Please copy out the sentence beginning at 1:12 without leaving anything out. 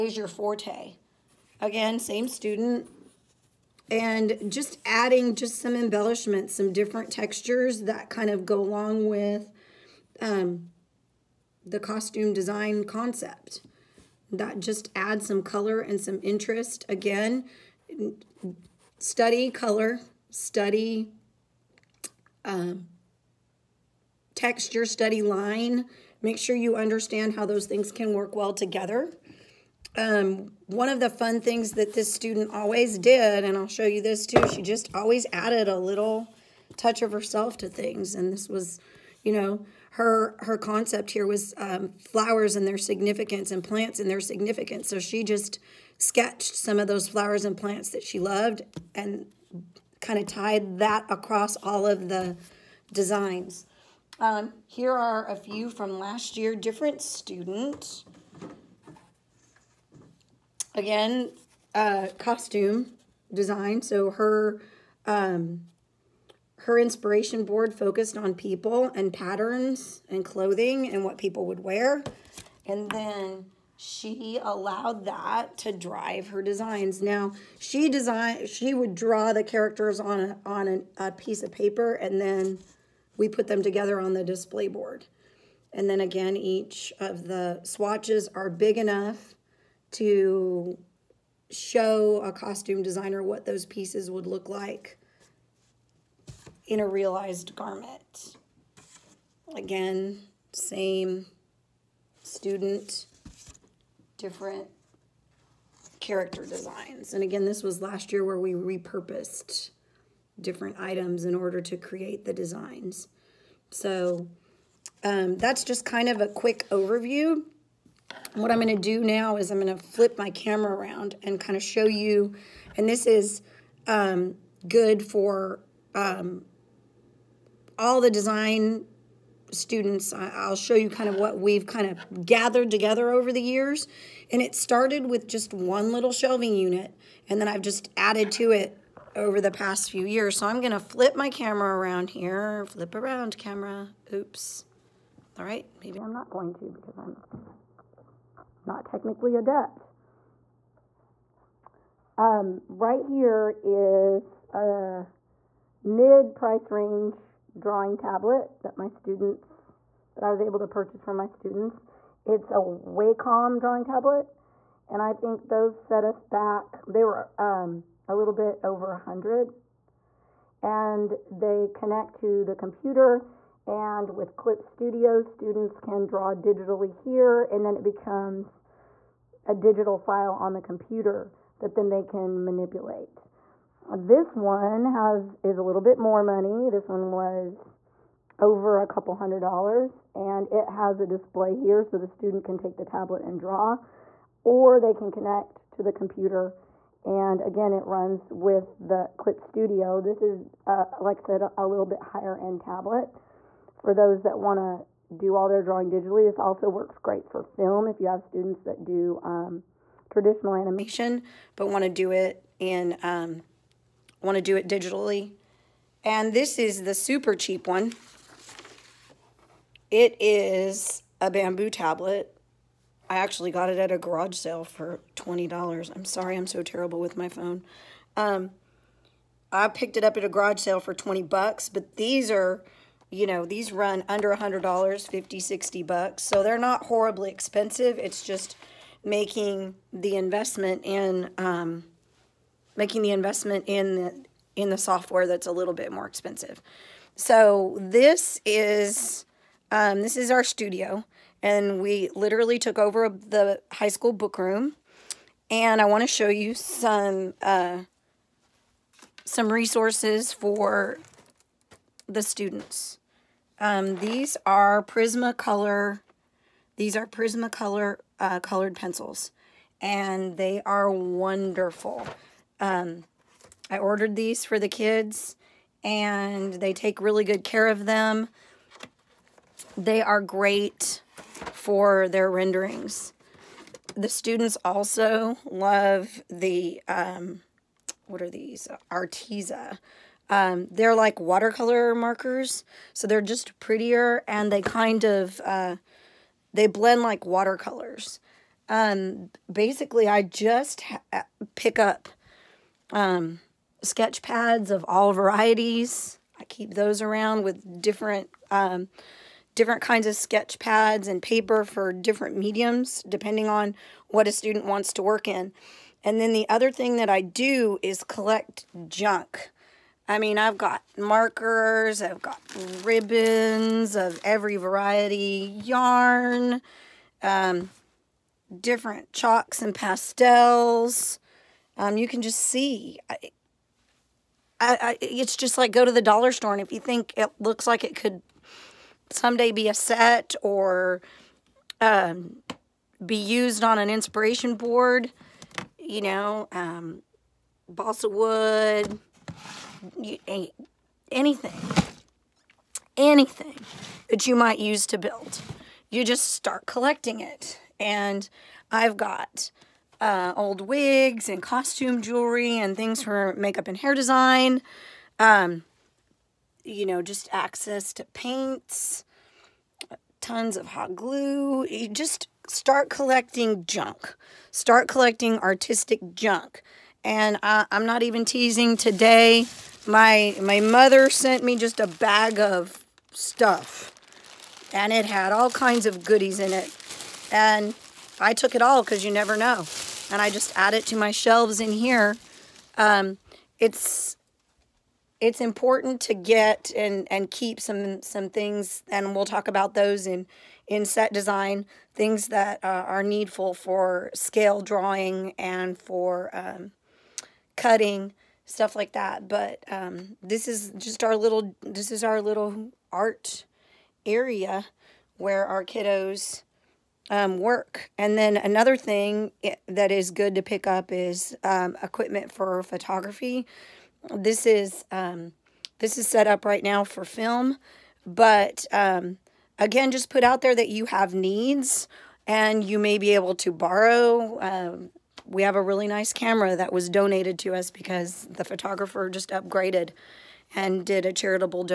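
And then she allowed that to drive her designs.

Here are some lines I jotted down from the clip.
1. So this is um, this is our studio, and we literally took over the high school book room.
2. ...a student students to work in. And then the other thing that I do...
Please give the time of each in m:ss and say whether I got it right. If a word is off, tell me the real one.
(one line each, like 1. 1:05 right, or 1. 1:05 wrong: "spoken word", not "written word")
1. 4:07 right
2. 5:14 wrong: "wants", not "students".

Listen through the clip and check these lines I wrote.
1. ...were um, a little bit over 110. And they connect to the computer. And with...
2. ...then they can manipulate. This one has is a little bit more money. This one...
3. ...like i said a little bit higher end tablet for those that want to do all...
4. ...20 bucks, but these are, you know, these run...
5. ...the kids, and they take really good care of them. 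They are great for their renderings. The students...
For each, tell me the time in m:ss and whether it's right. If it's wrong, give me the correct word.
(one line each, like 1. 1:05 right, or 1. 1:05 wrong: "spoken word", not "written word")
1. 2:47 wrong: "100", not "110"
2. 3:01 right
3. 3:20 right
4. 3:50 right
5. 4:34 right.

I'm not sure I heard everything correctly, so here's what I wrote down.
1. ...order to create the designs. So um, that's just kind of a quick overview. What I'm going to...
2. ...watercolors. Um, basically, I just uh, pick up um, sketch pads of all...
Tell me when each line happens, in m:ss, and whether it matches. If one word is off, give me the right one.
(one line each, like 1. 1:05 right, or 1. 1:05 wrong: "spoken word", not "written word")
1. 1:51 right
2. 4:57 right.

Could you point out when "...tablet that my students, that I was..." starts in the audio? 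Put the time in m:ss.
2:37.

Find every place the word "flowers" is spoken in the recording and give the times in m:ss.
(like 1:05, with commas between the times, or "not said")
0:41, 0:47.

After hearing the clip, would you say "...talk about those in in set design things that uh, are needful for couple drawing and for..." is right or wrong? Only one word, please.
wrong.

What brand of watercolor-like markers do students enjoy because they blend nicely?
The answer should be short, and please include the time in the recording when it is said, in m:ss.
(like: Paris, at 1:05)
Arteza, at 4:48.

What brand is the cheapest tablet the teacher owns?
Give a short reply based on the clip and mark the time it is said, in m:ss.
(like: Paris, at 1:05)
Bamboo, at 3:41.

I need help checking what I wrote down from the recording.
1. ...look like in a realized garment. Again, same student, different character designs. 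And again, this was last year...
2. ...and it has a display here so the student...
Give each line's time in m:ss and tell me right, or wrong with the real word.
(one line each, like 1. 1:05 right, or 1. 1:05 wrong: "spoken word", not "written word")
1. 1:34 right
2. 3:10 right.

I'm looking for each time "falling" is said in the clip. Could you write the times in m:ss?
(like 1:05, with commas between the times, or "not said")
not said.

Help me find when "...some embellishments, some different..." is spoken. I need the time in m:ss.
0:05.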